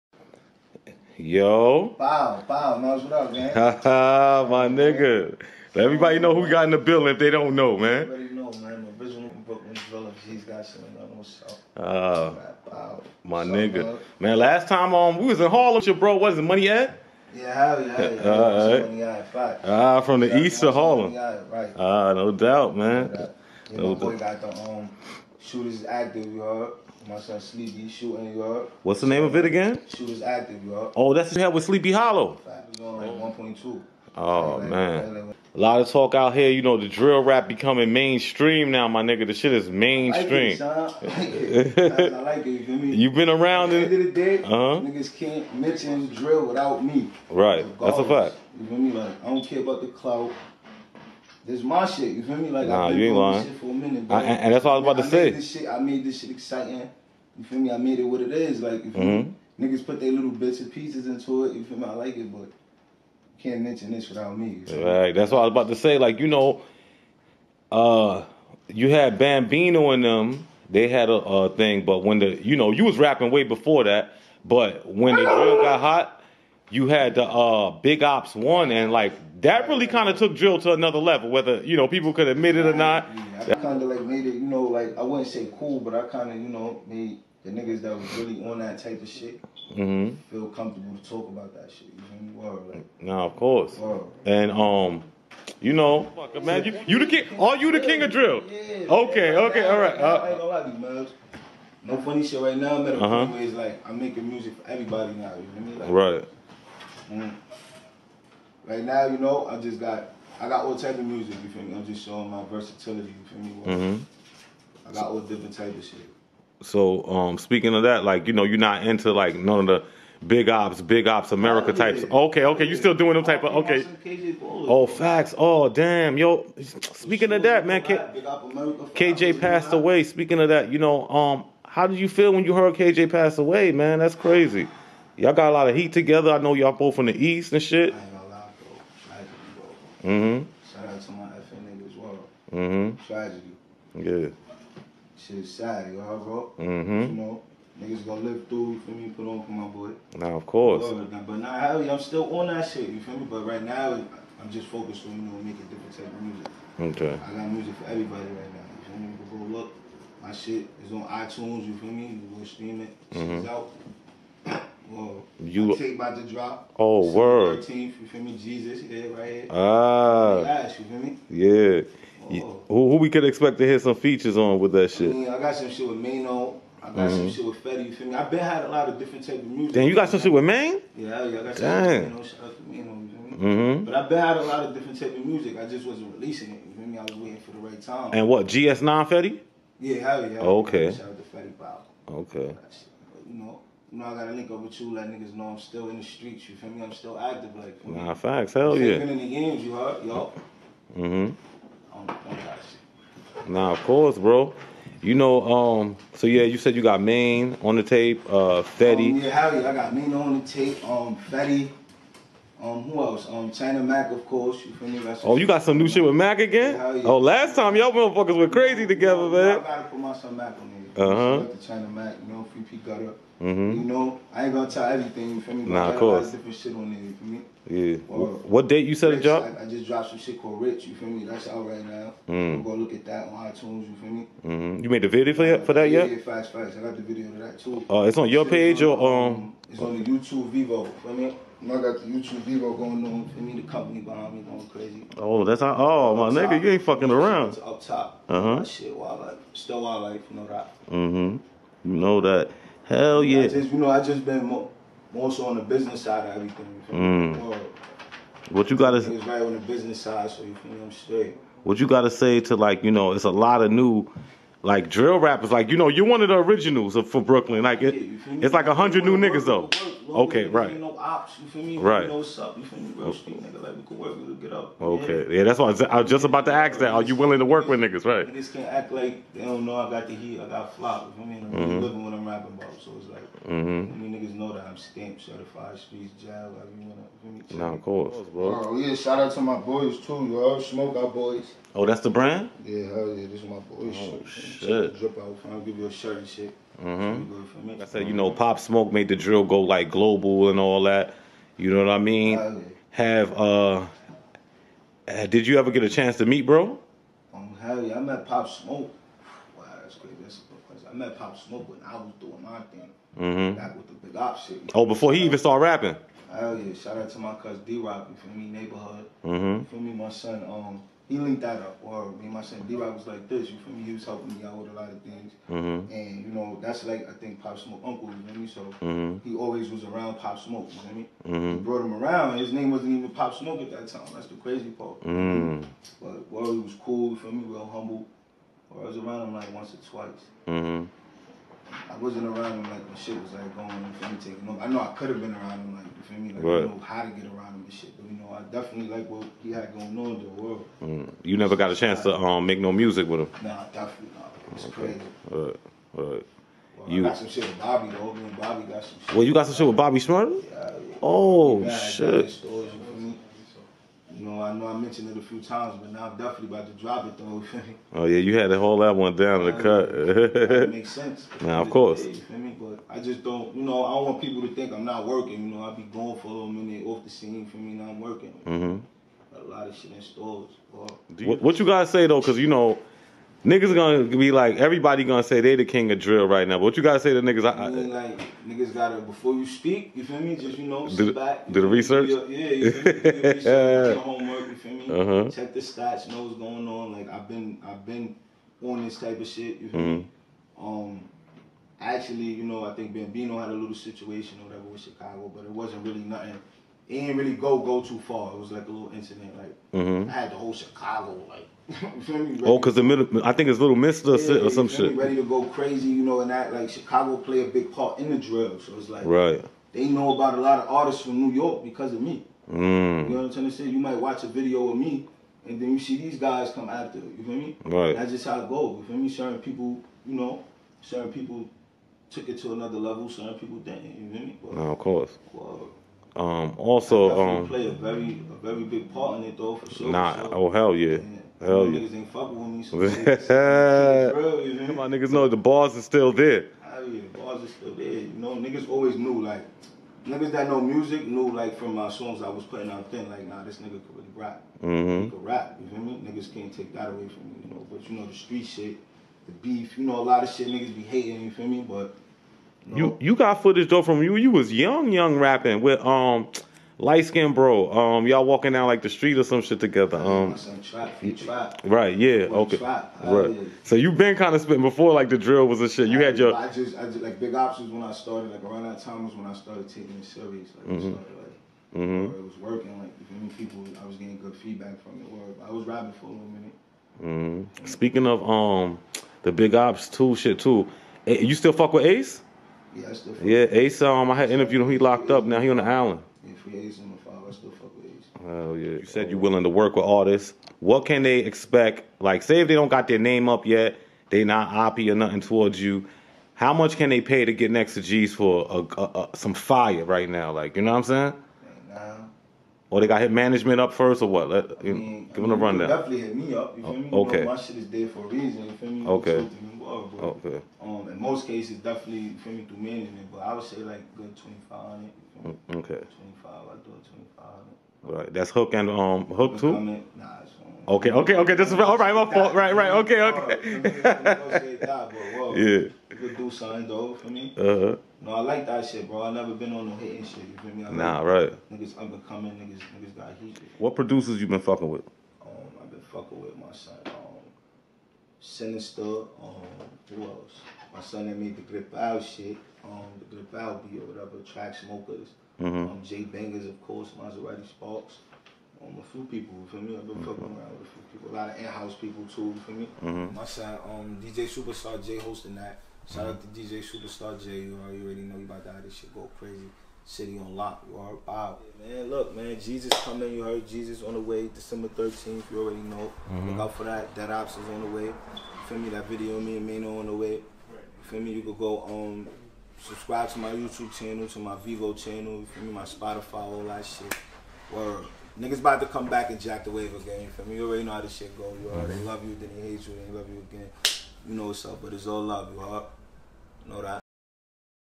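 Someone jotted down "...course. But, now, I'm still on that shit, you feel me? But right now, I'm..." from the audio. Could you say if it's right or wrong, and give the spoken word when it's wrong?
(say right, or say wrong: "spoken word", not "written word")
right.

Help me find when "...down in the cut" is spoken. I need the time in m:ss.
6:09.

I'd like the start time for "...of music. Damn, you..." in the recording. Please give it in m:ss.
2:59.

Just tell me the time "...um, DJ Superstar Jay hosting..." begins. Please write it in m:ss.
9:23.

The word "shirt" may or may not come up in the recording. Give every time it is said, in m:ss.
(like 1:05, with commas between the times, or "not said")
4:55.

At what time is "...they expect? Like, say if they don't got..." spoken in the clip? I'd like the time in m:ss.
8:21.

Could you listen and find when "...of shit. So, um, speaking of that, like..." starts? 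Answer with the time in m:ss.
1:55.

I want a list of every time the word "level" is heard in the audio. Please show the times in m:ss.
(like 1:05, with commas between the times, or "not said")
1:20, 7:12.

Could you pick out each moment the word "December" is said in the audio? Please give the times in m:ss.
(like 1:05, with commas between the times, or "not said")
2:47, 9:34.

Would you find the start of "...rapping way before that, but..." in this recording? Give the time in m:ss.
1:12.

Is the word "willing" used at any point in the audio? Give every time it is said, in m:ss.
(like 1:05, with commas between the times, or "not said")
4:37, 8:19.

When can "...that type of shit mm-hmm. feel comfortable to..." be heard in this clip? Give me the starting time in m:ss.
1:28.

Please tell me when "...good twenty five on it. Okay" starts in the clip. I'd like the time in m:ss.
8:43.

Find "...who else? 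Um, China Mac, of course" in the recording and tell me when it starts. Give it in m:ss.
3:32.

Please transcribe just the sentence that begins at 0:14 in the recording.
Man, last time um we was in Harlem, your bro wasn't money at?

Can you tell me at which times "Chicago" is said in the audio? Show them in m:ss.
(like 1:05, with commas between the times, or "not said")
6:44, 6:50, 6:56.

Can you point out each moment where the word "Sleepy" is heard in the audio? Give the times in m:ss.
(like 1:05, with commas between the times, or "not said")
0:27, 0:31.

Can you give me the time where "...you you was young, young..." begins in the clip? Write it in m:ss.
7:44.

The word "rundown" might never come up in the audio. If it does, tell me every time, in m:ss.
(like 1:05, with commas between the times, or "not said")
8:35.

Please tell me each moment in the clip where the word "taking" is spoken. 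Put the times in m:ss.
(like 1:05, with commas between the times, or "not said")
5:44, 7:59.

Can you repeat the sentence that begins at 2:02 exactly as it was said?
Okay, okay, you still doing them type of okay.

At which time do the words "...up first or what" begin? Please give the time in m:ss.
8:33.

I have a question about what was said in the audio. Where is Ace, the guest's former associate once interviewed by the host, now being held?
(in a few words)
the island.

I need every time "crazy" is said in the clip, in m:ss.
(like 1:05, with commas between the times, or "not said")
2:14, 3:38, 4:04, 5:09, 5:34, 5:55, 6:55, 9:29.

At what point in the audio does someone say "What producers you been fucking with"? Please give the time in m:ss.
9:03.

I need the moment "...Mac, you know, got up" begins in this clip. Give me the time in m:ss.
3:41.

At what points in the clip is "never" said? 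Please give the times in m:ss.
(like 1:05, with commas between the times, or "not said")
5:51, 8:59.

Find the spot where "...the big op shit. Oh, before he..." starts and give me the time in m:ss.
5:13.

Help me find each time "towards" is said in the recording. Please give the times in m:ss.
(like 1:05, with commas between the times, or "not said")
8:25.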